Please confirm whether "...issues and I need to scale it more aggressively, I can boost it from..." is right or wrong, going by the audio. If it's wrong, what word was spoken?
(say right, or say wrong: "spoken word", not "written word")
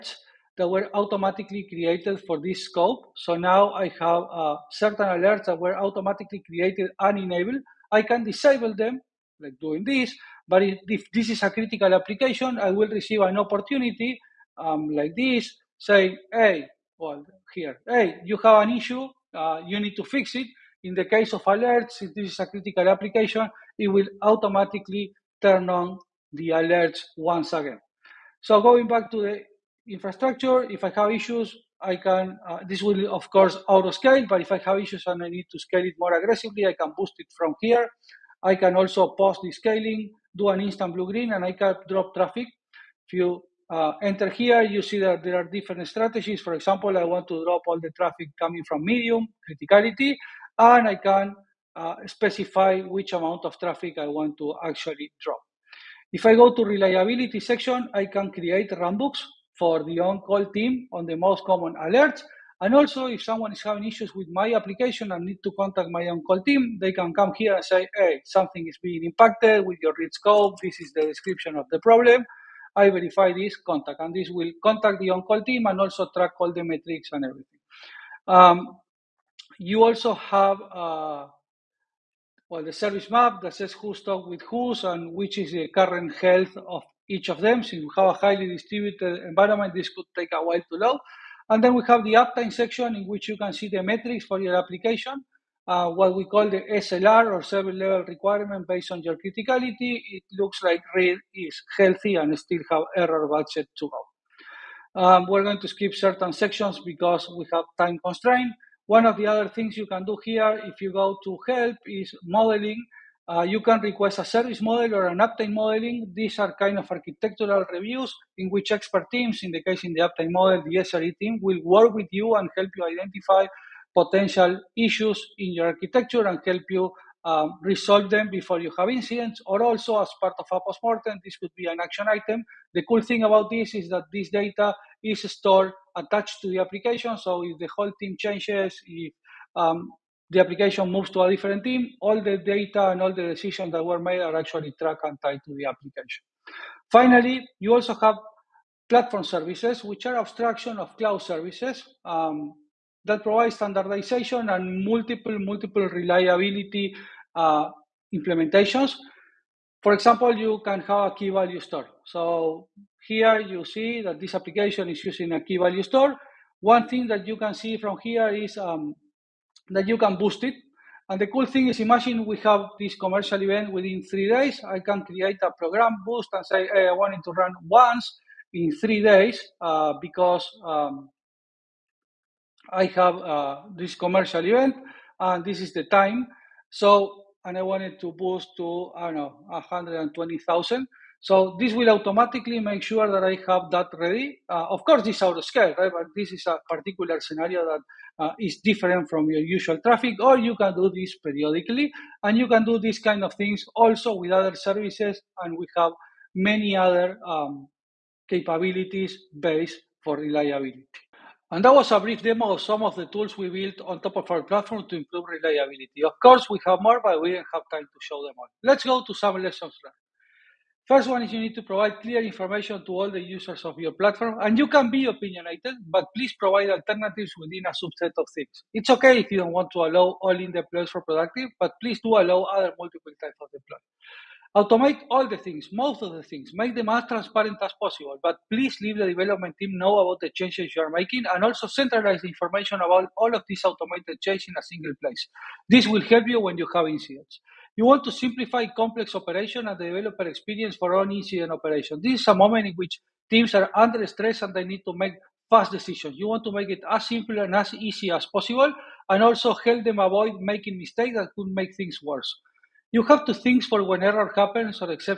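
right.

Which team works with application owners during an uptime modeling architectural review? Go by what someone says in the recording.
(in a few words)
The SRE team.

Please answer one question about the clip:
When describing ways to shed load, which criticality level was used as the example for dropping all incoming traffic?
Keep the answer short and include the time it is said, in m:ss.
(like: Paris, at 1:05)
Medium, at 0:48.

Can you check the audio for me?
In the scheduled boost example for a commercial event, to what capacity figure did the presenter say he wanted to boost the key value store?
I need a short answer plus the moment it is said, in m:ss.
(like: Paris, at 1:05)
120,000, at 3:09.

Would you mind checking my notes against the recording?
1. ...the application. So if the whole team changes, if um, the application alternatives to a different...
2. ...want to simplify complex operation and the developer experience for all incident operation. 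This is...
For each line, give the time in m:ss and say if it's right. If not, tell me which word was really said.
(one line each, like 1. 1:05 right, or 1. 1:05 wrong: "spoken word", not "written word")
1. 2:16 wrong: "moves", not "alternatives"
2. 4:07 right.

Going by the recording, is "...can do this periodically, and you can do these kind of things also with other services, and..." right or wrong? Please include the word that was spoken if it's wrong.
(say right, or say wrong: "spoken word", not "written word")
right.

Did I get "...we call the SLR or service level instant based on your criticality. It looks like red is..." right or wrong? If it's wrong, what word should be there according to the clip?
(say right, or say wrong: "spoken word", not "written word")
wrong: "requirement", not "instant".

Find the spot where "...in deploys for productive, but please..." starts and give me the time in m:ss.
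3:50.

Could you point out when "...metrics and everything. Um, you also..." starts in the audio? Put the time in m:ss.
1:16.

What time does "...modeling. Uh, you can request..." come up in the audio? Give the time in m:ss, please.
1:52.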